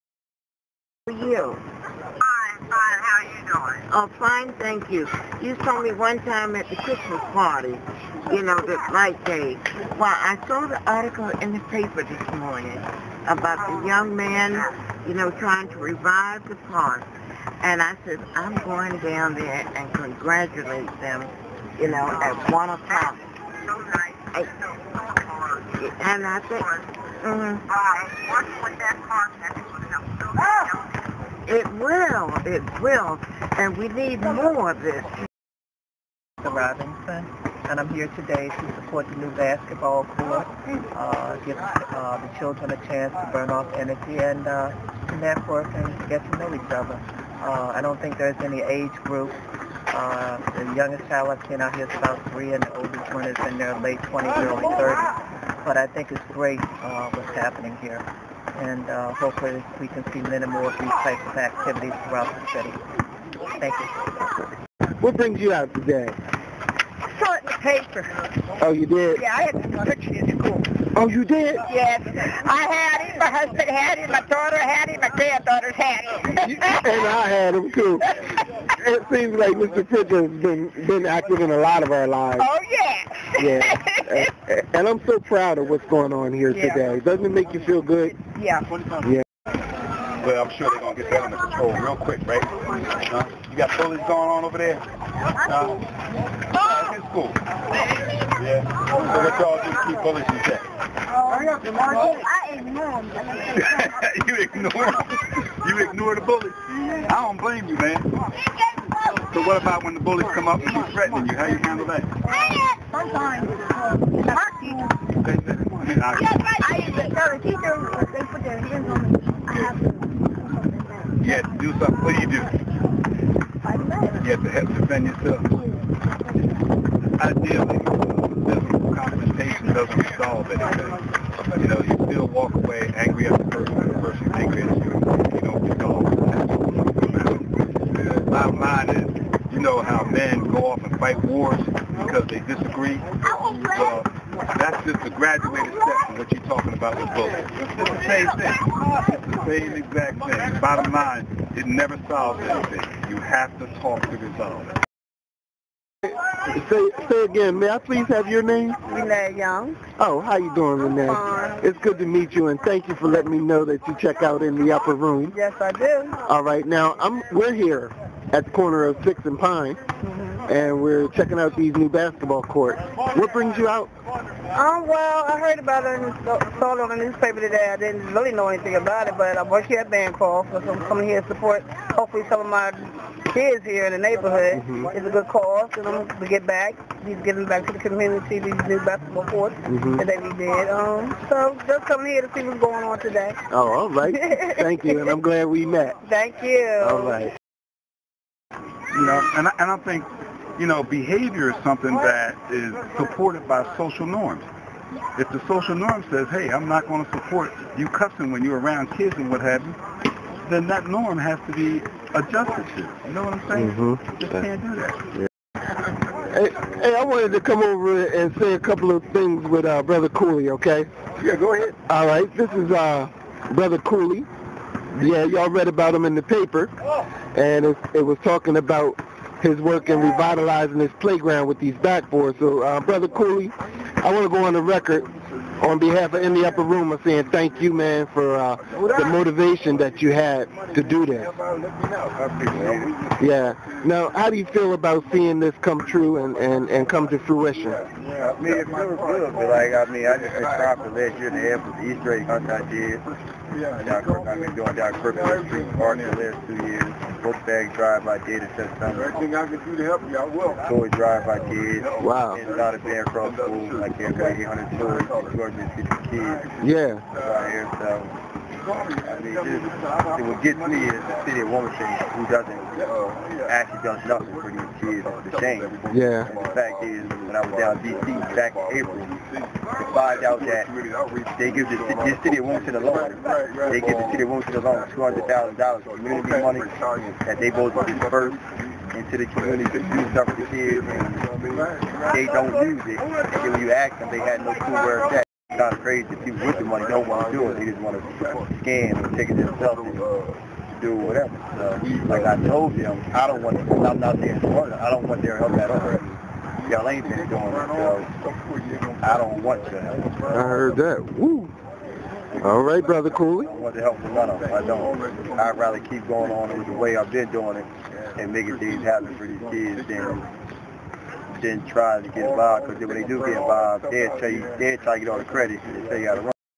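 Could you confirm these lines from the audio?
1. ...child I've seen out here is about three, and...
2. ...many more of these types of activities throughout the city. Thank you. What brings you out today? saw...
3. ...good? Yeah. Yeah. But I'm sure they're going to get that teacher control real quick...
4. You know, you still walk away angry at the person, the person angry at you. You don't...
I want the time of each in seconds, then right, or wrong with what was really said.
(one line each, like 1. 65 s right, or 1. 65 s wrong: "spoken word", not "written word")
1. 51 s right
2. 60 s right
3. 87 s wrong: "under", not "teacher"
4. 131 s right.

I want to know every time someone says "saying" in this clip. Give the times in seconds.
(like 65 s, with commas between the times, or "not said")
213 s, 237 s.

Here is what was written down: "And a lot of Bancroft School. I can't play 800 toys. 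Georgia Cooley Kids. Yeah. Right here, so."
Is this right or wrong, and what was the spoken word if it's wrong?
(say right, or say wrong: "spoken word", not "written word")
wrong: "City", not "Cooley".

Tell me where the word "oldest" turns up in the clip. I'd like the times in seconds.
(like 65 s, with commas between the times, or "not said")
52 s.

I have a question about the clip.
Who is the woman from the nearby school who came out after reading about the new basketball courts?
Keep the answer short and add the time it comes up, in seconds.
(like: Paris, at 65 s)
Renee Young, at 158 s.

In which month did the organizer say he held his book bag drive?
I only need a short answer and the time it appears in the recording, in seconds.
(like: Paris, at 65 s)
September, at 258 s.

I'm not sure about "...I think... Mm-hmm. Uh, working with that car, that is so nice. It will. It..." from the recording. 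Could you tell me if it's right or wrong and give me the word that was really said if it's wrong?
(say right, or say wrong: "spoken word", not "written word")
right.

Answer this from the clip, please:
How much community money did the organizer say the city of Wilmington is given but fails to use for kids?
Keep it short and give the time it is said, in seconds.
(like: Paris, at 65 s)
$200,000, at 284 s.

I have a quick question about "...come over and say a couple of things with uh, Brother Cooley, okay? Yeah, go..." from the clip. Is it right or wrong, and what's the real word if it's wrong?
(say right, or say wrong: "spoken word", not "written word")
right.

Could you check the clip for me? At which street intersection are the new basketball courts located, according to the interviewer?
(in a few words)
Sixth and Pine.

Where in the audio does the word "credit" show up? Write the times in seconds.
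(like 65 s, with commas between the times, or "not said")
325 s.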